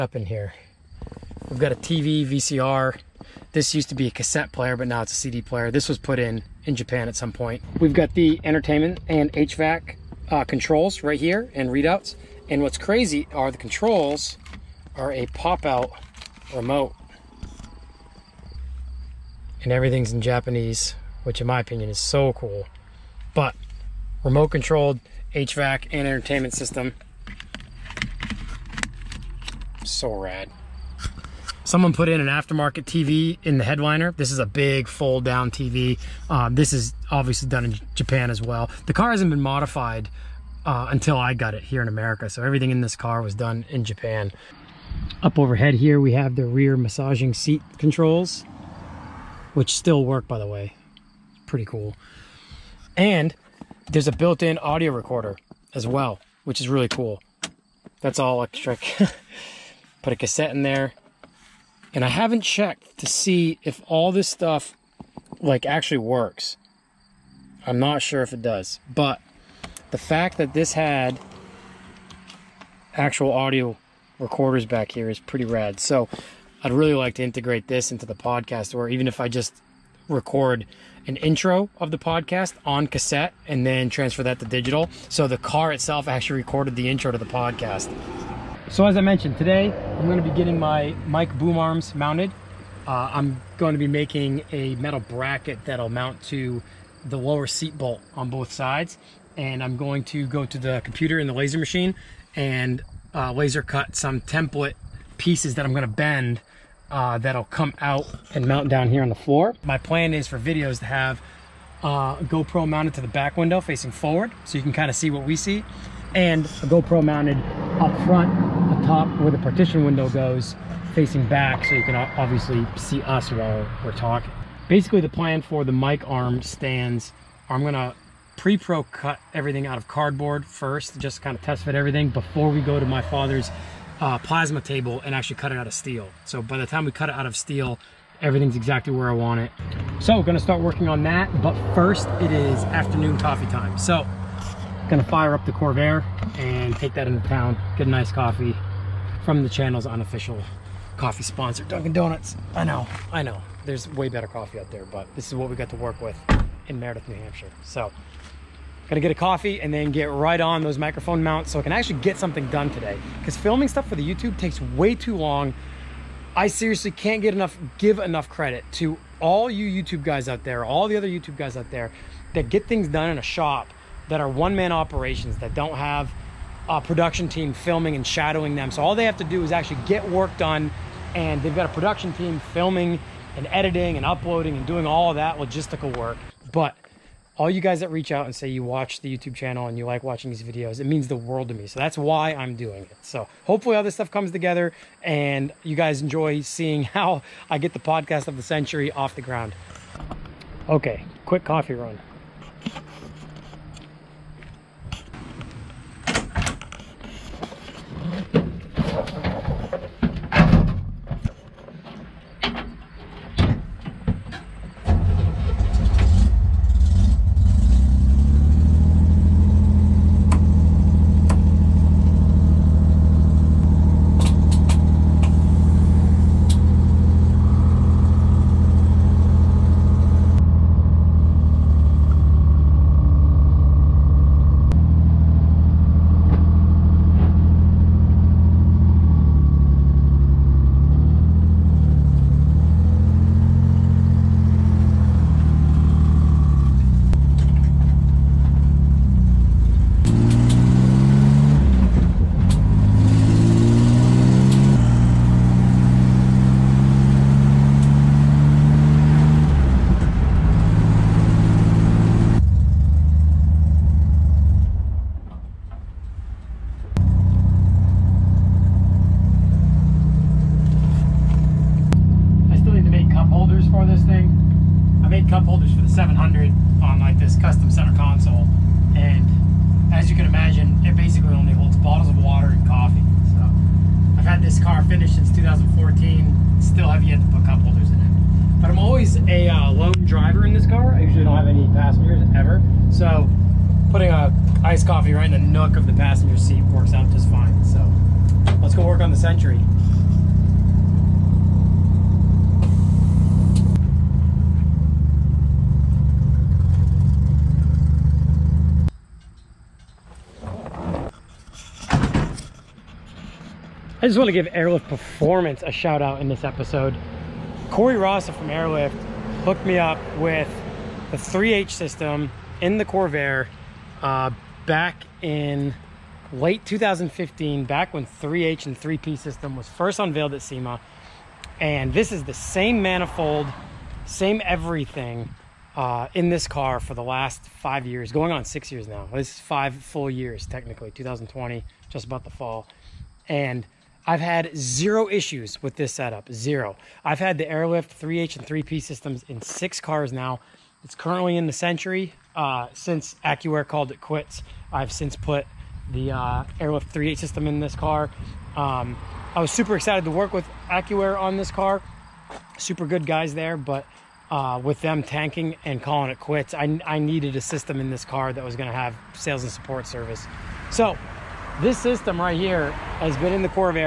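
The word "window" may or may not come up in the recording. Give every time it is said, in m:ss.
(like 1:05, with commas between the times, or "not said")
1:53, 1:59.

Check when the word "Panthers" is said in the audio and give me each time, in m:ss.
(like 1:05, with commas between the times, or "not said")
not said.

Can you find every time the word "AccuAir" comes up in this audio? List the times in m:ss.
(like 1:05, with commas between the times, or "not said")
5:53, 6:00.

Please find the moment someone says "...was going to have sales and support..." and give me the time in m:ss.
6:08.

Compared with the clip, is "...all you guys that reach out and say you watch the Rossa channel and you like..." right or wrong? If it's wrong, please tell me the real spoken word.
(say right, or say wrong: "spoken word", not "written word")
wrong: "YouTube", not "Rossa".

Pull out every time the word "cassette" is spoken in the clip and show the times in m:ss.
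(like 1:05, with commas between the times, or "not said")
0:04, 1:00, 1:22.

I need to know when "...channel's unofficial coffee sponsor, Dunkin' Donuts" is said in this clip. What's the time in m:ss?
2:29.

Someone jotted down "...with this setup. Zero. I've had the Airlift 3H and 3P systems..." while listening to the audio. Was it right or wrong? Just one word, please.
right.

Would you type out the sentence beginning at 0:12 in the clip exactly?
And what's crazy are the controls are a pop-out remote.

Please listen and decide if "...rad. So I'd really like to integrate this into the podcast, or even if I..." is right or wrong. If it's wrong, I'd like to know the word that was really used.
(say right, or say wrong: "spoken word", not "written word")
right.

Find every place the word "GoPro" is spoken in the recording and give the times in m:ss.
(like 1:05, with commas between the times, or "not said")
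1:52, 1:56.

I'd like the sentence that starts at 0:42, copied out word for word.
So everything in this car was done in Japan.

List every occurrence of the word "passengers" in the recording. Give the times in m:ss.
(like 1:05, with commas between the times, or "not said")
4:51, 4:55.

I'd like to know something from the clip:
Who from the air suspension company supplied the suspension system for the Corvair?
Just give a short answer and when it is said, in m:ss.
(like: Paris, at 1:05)
Corey Rossa, at 5:17.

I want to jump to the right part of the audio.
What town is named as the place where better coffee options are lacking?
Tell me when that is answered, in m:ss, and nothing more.
2:36.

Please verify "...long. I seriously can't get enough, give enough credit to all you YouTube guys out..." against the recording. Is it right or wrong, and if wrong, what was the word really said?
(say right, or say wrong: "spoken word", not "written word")
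right.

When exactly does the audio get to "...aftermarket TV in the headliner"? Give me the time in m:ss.
0:32.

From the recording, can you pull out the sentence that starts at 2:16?
So by the time we cut it out of steel, everything's exactly where I want it.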